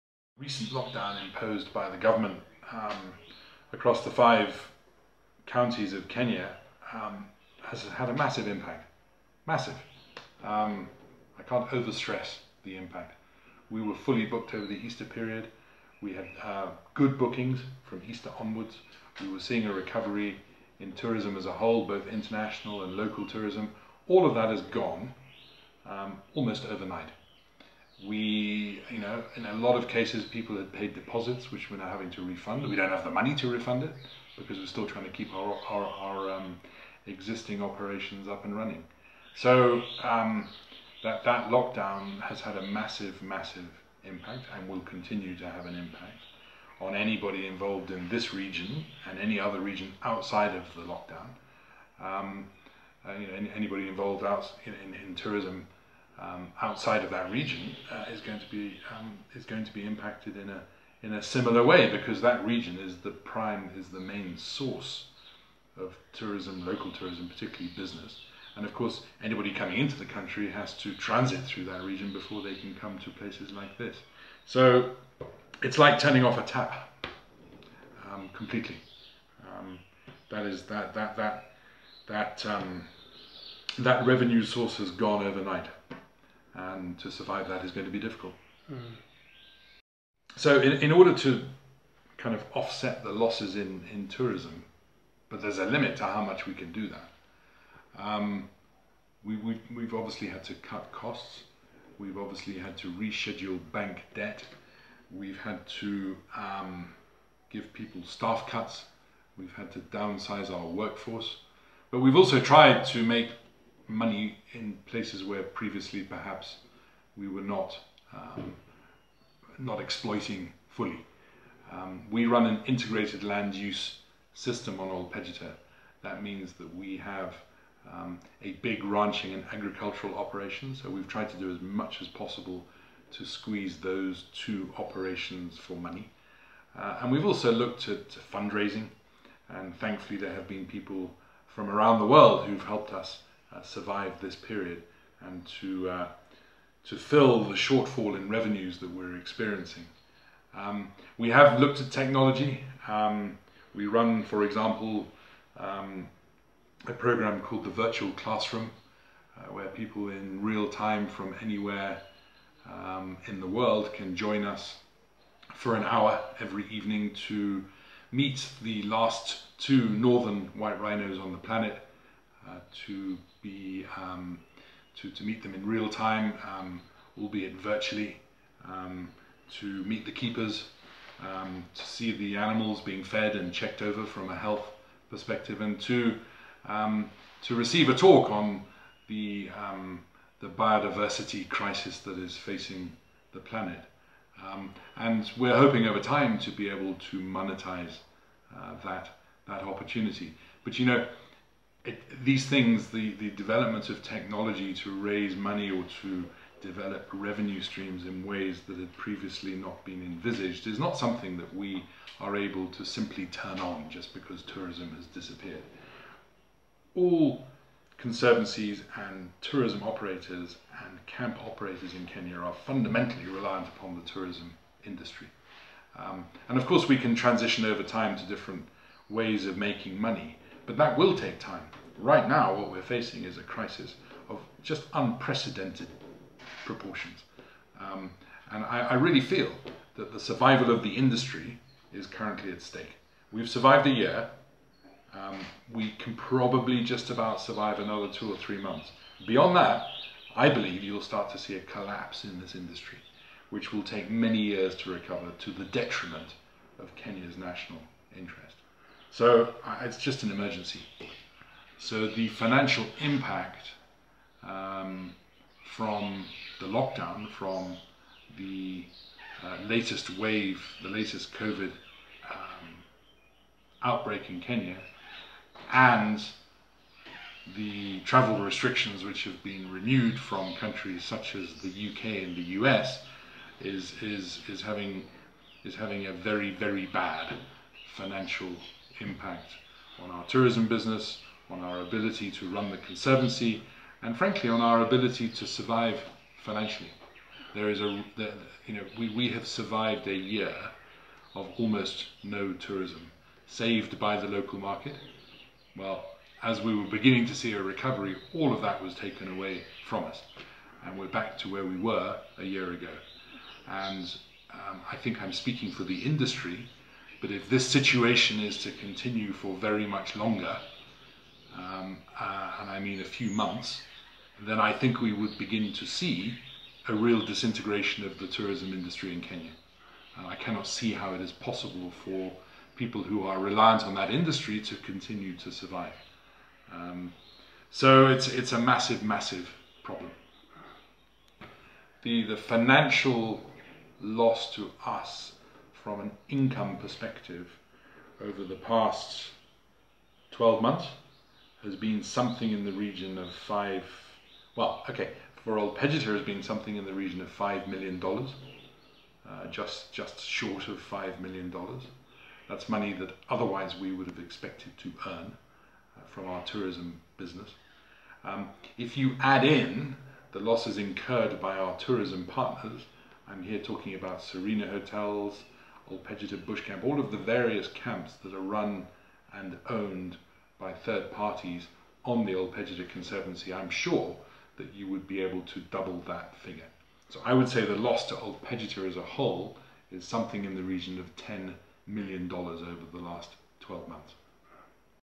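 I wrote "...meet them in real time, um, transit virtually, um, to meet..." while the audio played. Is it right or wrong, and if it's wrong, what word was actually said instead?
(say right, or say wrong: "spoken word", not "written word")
wrong: "albeit", not "transit".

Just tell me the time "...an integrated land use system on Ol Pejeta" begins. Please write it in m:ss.
2:02.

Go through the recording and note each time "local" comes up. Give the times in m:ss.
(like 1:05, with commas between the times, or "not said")
0:22, 1:06, 5:04.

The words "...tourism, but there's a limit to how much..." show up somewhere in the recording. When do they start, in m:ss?
1:34.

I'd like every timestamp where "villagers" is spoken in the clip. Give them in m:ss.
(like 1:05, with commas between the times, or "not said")
not said.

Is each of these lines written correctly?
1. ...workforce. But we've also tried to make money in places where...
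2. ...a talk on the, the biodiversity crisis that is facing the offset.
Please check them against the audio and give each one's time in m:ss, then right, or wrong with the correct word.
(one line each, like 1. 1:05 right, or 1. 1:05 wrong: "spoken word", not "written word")
1. 1:50 right
2. 3:07 wrong: "planet", not "offset".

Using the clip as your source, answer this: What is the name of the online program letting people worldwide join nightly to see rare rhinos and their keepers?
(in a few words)
Virtual Classroom.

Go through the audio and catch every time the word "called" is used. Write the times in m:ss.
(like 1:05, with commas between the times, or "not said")
2:37.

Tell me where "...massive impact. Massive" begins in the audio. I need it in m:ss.
0:08.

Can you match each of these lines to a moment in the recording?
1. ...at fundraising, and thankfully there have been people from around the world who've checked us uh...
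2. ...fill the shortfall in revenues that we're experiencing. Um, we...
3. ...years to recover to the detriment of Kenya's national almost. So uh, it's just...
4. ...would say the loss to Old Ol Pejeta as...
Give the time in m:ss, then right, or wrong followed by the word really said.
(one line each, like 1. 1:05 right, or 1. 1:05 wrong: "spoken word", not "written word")
1. 2:17 wrong: "helped", not "checked"
2. 2:26 right
3. 4:14 wrong: "interest", not "almost"
4. 6:27 right.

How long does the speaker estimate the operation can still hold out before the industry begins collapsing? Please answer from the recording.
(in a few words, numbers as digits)
2 or 3 months.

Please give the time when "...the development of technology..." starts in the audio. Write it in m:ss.
3:23.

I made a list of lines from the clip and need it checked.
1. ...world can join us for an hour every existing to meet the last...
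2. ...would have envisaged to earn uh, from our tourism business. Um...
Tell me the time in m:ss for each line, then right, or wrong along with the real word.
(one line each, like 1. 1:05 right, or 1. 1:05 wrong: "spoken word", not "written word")
1. 2:43 wrong: "evening", not "existing"
2. 6:03 wrong: "expected", not "envisaged".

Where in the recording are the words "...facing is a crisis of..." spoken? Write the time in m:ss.
3:52.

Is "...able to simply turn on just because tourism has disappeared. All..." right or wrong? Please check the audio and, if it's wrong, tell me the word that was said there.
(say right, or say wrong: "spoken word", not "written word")
right.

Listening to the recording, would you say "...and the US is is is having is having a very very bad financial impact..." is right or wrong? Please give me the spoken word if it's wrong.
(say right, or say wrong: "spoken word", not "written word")
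right.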